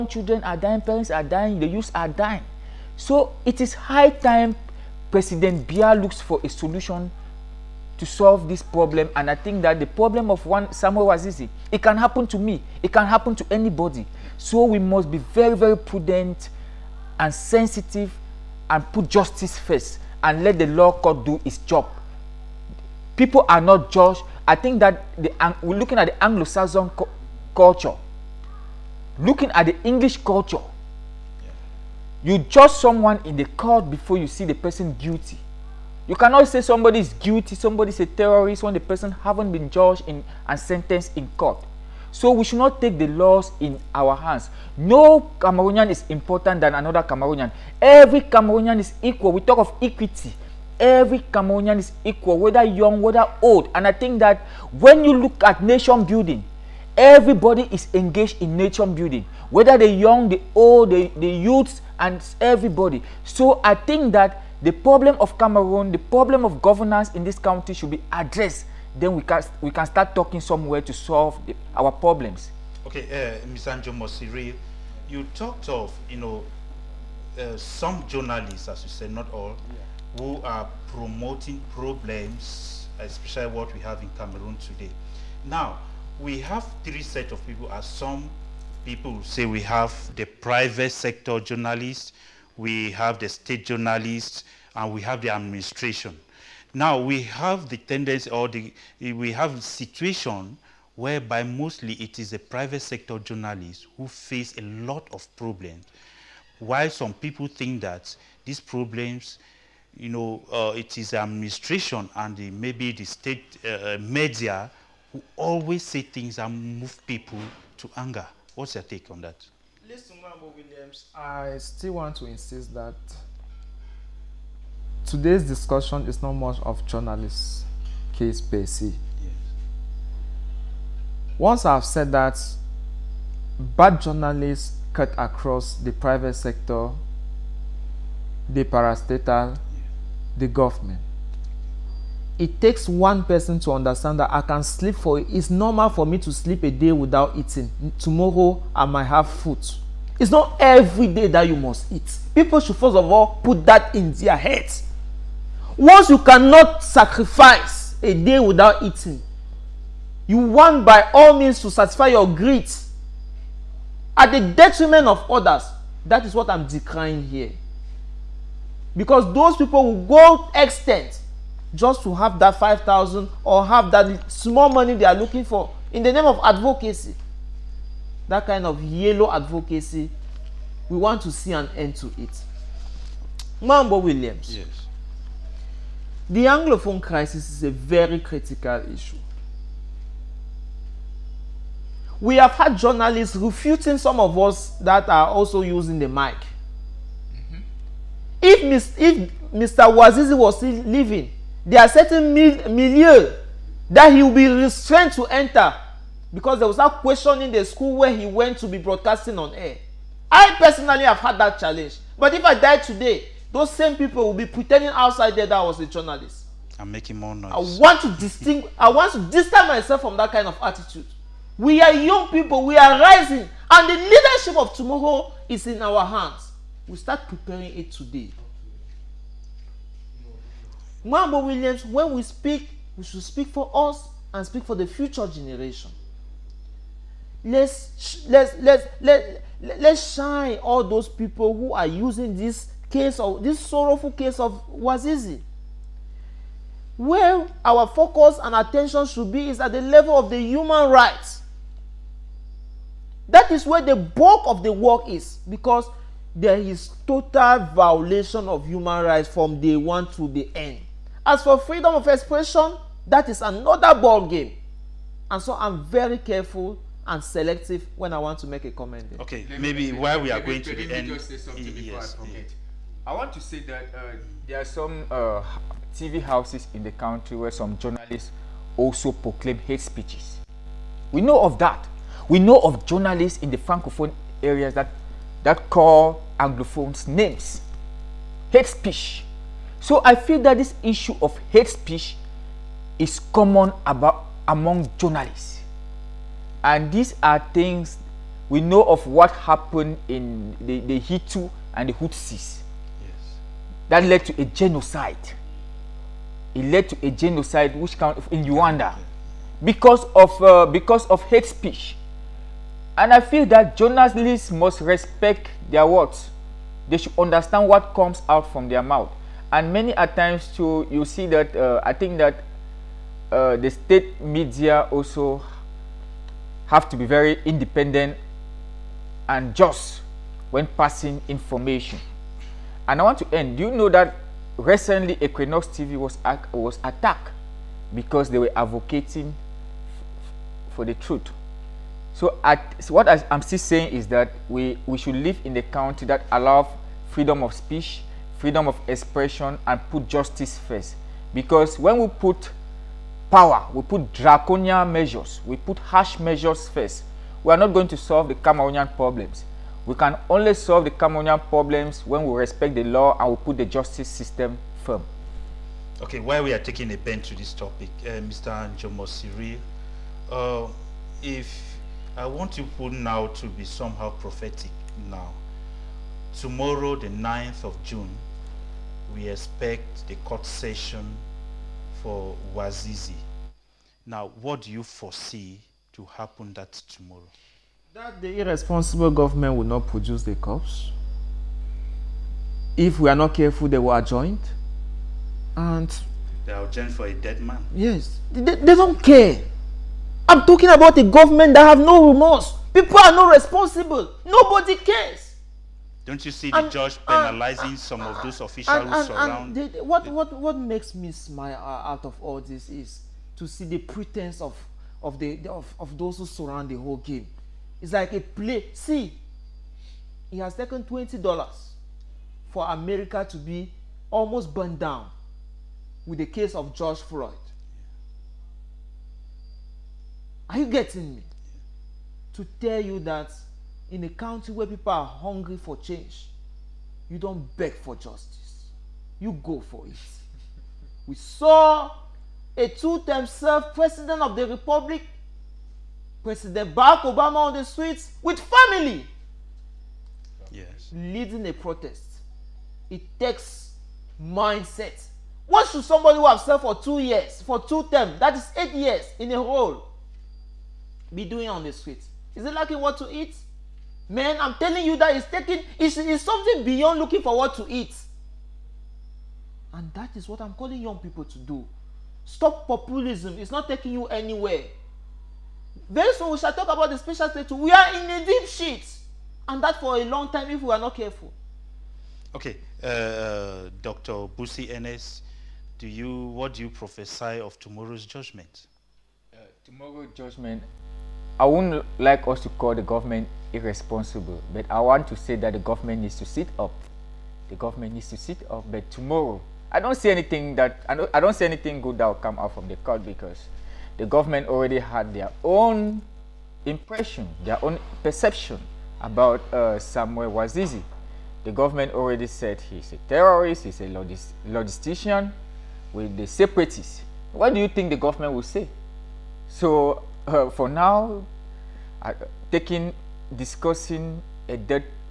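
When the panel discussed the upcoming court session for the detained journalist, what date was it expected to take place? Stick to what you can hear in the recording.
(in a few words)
9th of June.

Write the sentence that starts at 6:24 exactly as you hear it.
Now, what do you foresee to happen that tomorrow?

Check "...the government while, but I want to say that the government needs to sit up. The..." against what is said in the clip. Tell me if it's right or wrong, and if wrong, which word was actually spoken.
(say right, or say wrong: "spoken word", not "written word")
wrong: "irresponsible", not "while".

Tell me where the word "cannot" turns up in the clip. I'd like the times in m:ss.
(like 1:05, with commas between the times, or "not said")
0:36, 2:36.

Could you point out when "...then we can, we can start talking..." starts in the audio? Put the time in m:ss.
1:08.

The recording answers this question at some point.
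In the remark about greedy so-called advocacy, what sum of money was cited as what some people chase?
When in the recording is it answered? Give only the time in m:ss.
2:52.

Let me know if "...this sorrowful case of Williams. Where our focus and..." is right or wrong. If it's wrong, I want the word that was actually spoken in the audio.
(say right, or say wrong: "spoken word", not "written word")
wrong: "Wazizi", not "Williams".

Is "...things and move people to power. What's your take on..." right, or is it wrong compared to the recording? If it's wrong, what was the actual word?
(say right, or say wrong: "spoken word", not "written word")
wrong: "anger", not "power".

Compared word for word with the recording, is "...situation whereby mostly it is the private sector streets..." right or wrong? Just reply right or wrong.
wrong.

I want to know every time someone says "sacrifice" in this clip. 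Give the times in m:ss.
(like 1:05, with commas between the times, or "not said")
2:36.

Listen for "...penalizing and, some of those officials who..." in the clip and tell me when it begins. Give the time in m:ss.
6:47.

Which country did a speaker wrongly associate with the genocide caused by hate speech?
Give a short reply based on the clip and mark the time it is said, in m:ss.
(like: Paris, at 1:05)
Uganda, at 5:08.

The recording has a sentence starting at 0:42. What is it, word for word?
So we should not take the laws in our hands.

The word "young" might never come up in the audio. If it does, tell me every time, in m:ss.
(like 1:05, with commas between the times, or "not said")
0:52, 0:59, 3:41, 7:50.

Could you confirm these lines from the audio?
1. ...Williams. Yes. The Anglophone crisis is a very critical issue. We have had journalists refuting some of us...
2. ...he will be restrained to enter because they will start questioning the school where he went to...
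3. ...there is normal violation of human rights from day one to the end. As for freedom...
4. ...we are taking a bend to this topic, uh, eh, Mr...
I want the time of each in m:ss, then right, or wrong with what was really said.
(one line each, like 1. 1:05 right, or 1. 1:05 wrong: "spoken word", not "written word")
1. 3:03 right
2. 3:24 right
3. 4:16 wrong: "total", not "normal"
4. 6:06 right.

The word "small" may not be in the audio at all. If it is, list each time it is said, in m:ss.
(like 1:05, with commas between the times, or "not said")
2:54.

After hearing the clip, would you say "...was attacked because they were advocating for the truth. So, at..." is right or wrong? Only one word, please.
right.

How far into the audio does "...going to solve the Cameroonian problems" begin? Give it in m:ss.
5:57.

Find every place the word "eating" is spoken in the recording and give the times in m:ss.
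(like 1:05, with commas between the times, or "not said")
2:27, 2:38.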